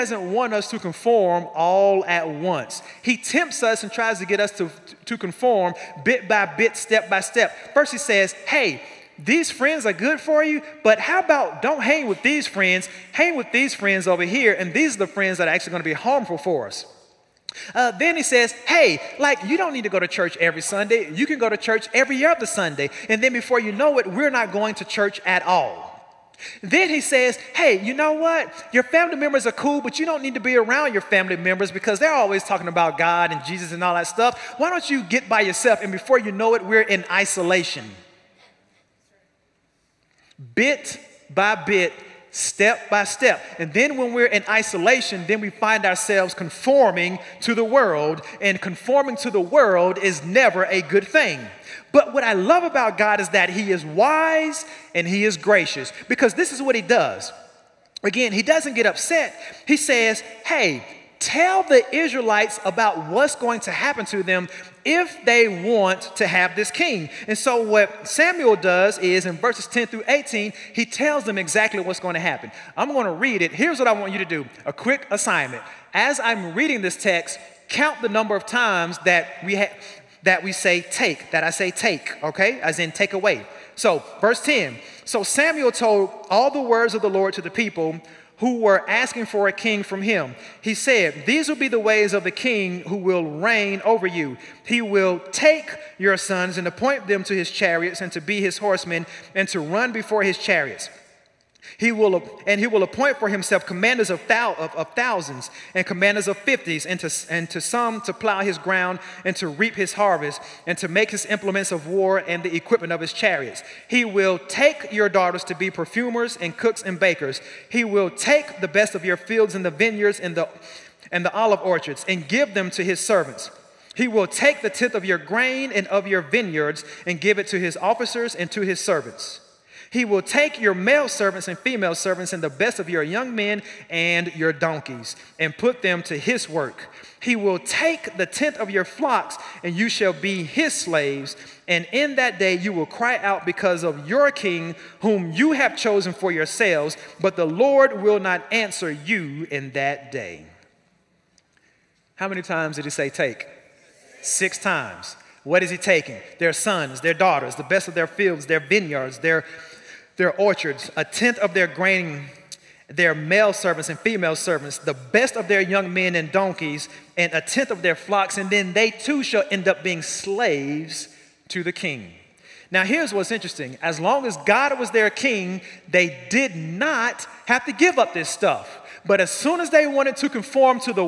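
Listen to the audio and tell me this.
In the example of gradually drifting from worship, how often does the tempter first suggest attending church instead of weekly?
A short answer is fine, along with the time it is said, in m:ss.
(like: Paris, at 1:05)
Every other Sunday, at 0:21.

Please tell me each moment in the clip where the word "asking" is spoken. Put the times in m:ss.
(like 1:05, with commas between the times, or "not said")
1:28.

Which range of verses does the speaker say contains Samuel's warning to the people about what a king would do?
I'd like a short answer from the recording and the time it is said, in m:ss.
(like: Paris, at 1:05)
Verses 10 through 18, at 1:09.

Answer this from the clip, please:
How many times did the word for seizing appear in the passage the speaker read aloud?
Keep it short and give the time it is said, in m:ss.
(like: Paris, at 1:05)
6, at 2:34.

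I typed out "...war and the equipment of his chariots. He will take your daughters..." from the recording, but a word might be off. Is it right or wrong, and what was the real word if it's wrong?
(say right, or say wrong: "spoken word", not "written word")
right.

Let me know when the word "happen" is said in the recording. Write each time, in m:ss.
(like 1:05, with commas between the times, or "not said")
1:03, 1:12.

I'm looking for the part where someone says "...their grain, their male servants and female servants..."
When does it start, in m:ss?
2:41.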